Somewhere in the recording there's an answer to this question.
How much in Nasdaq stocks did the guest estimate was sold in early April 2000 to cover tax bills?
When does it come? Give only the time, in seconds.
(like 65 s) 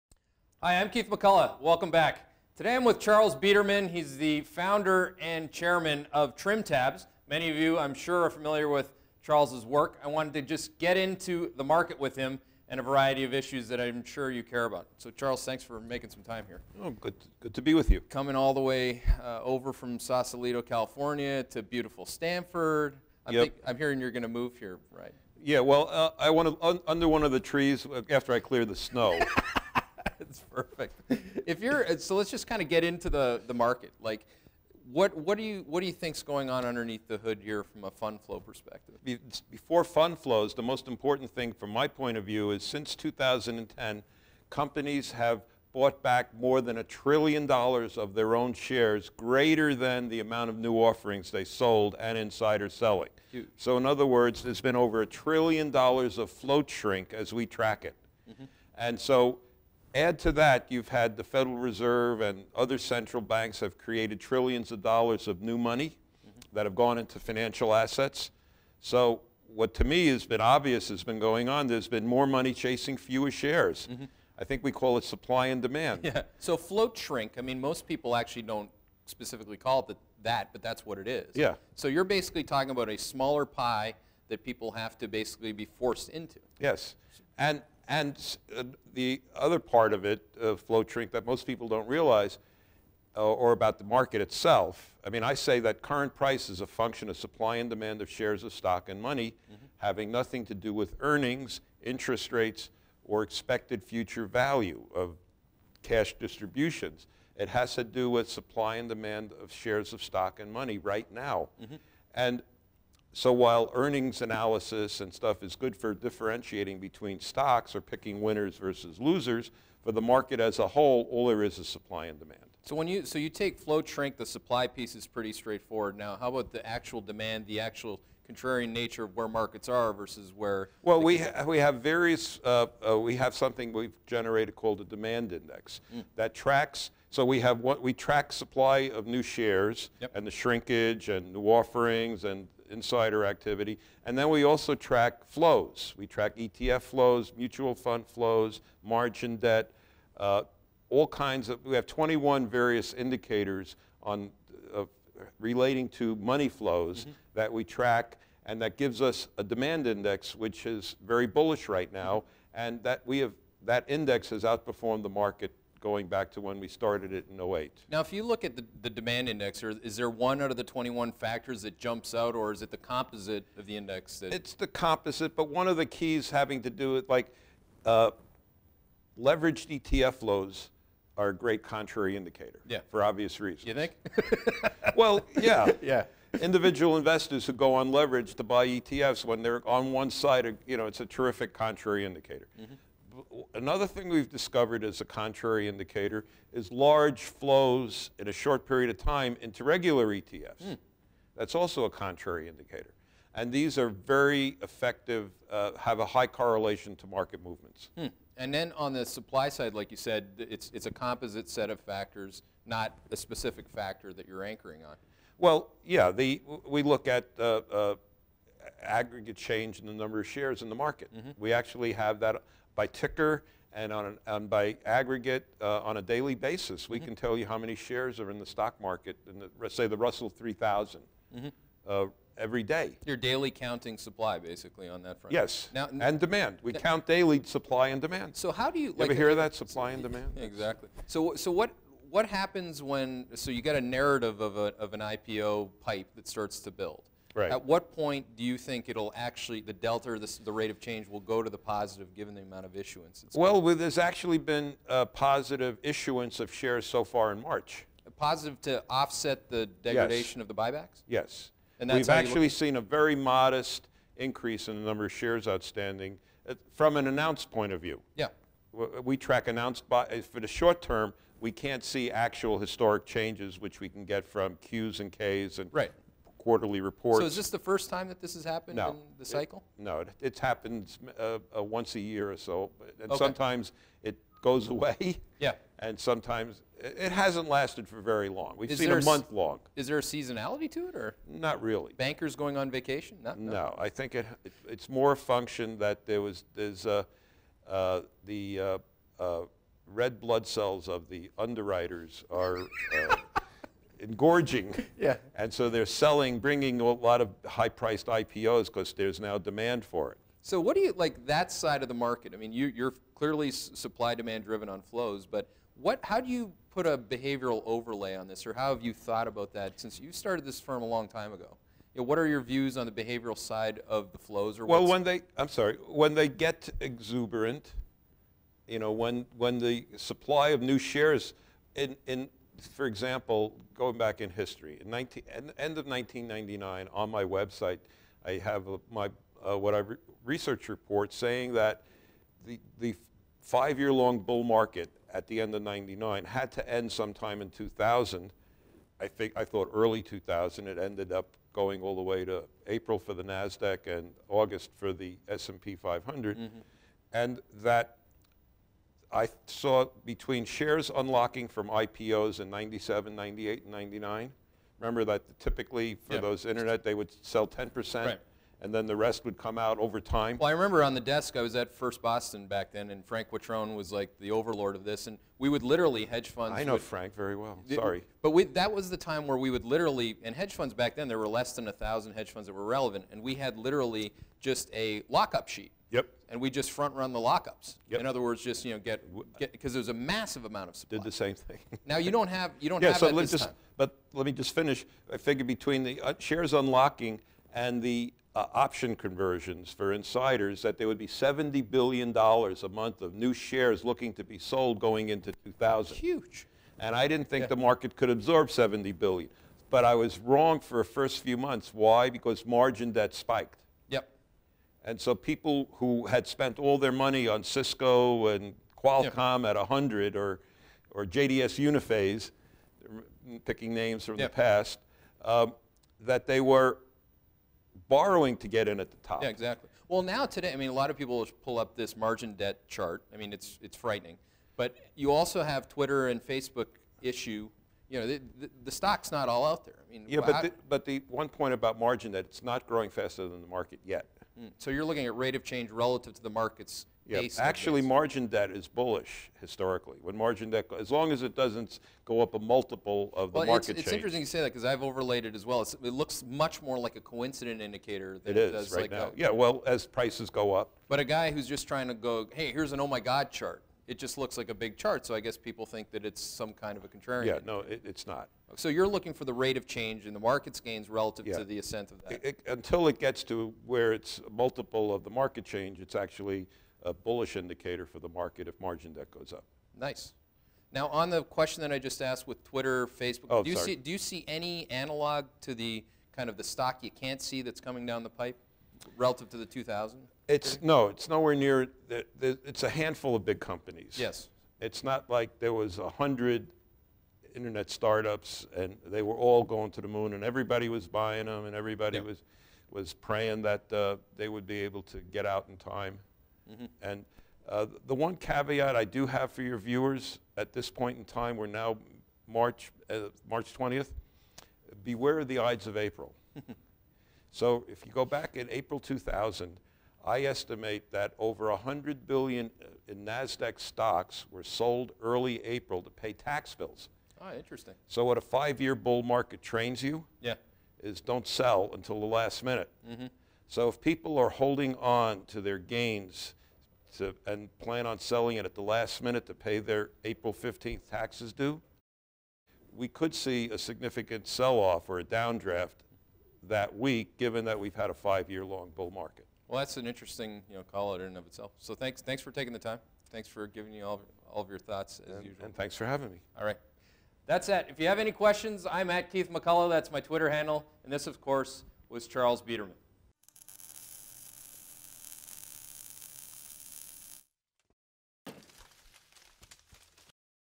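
521 s.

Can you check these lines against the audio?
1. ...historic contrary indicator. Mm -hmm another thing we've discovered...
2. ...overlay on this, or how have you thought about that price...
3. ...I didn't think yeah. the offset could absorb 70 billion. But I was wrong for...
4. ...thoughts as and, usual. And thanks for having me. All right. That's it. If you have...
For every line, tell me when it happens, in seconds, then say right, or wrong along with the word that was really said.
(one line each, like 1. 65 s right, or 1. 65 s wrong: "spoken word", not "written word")
1. 191 s wrong: "terrific", not "historic"
2. 317 s wrong: "since", not "price"
3. 406 s wrong: "market", not "offset"
4. 554 s right.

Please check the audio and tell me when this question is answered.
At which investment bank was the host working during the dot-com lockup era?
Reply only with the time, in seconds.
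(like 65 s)
371 s.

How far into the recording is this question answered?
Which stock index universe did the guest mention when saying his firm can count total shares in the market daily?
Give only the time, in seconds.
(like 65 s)
229 s.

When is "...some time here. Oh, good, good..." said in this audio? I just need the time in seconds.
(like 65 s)
16 s.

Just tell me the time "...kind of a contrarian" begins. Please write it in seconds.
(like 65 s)
466 s.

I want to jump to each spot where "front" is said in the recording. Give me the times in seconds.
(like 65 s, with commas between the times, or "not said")
235 s, 386 s.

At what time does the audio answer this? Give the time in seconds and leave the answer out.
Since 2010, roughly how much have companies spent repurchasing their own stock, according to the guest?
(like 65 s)
46 s.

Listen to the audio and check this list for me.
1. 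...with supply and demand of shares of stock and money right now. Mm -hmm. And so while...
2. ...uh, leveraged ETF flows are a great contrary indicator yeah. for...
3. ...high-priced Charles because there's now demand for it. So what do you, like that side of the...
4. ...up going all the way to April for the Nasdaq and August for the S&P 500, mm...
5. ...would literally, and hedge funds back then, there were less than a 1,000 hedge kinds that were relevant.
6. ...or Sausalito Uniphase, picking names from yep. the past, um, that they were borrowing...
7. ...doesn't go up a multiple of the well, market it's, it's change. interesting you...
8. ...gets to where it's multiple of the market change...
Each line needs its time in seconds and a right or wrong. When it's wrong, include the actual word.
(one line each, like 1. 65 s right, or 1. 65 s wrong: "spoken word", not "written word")
1. 108 s right
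2. 177 s right
3. 307 s wrong: "IPOs", not "Charles"
4. 351 s right
5. 379 s wrong: "funds", not "kinds"
6. 420 s wrong: "JDS", not "Sausalito"
7. 451 s right
8. 472 s right.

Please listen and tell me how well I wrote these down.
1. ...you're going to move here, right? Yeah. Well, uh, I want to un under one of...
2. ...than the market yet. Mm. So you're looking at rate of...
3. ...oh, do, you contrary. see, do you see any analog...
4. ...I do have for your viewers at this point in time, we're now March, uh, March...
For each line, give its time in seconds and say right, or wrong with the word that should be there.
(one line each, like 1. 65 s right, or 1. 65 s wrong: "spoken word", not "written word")
1. 23 s right
2. 443 s right
3. 483 s wrong: "sorry", not "contrary"
4. 508 s right.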